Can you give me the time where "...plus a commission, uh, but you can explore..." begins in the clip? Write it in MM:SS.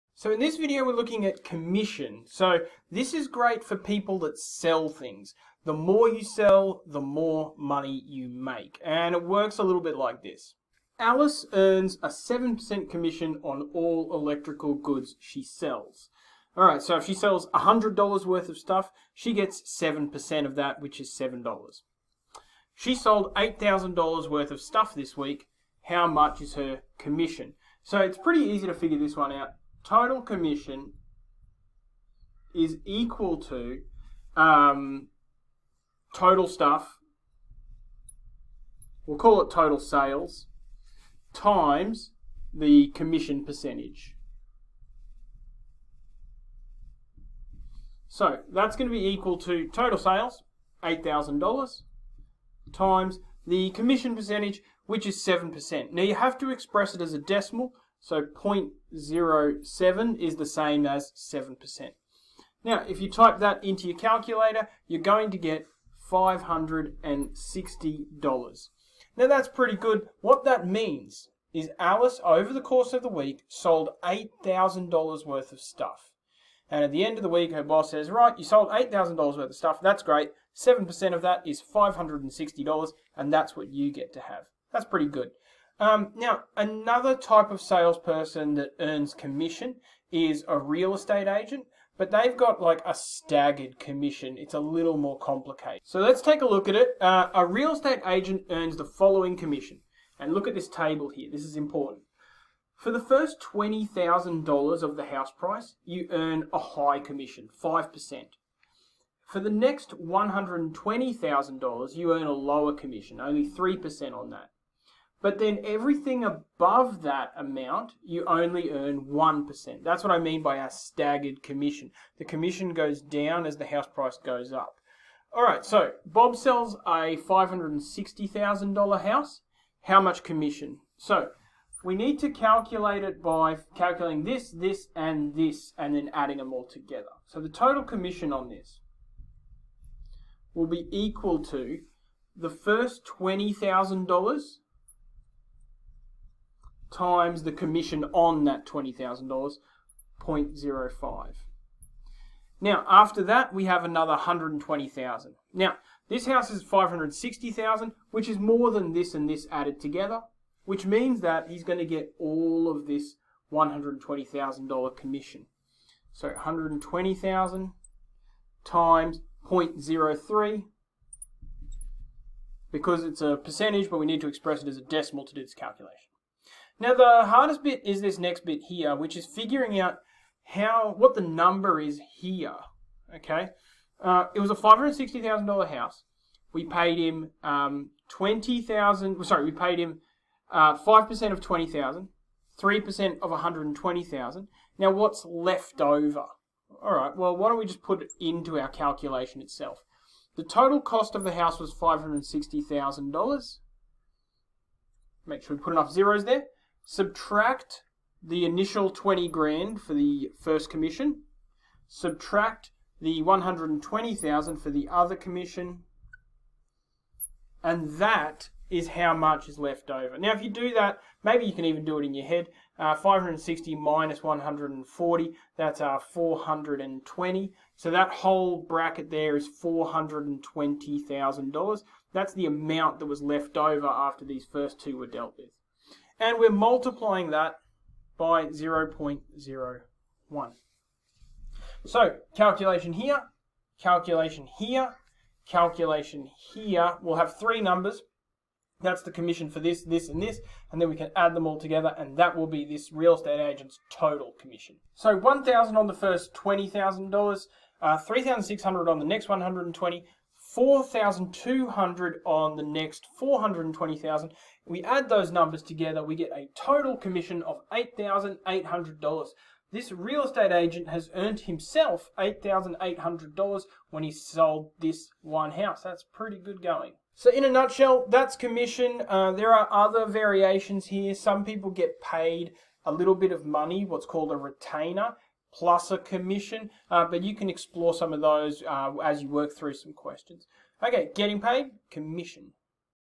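04:45.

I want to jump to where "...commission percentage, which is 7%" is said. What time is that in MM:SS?
00:53.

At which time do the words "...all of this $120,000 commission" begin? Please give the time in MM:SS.
02:42.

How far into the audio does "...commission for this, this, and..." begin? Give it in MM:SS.
04:09.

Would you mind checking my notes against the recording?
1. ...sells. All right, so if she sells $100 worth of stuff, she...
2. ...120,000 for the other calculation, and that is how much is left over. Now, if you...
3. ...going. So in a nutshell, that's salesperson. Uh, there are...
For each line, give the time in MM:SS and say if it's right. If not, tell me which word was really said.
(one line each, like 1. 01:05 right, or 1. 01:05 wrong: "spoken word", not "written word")
1. 00:15 right
2. 03:33 wrong: "commission", not "calculation"
3. 04:36 wrong: "commission", not "salesperson".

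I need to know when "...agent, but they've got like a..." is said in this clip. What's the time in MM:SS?
01:31.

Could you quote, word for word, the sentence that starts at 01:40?
And look at this table here.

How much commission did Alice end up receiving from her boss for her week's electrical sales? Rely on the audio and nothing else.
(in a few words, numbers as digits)
$560.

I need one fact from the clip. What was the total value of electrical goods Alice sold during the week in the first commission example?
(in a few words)
$8,000.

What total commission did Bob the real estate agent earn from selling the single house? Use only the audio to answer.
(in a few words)
$8,800.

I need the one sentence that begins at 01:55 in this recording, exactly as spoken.
But then everything above that amount, you only earn 1%.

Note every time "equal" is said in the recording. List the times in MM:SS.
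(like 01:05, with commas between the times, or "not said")
00:32, 00:49, 02:20.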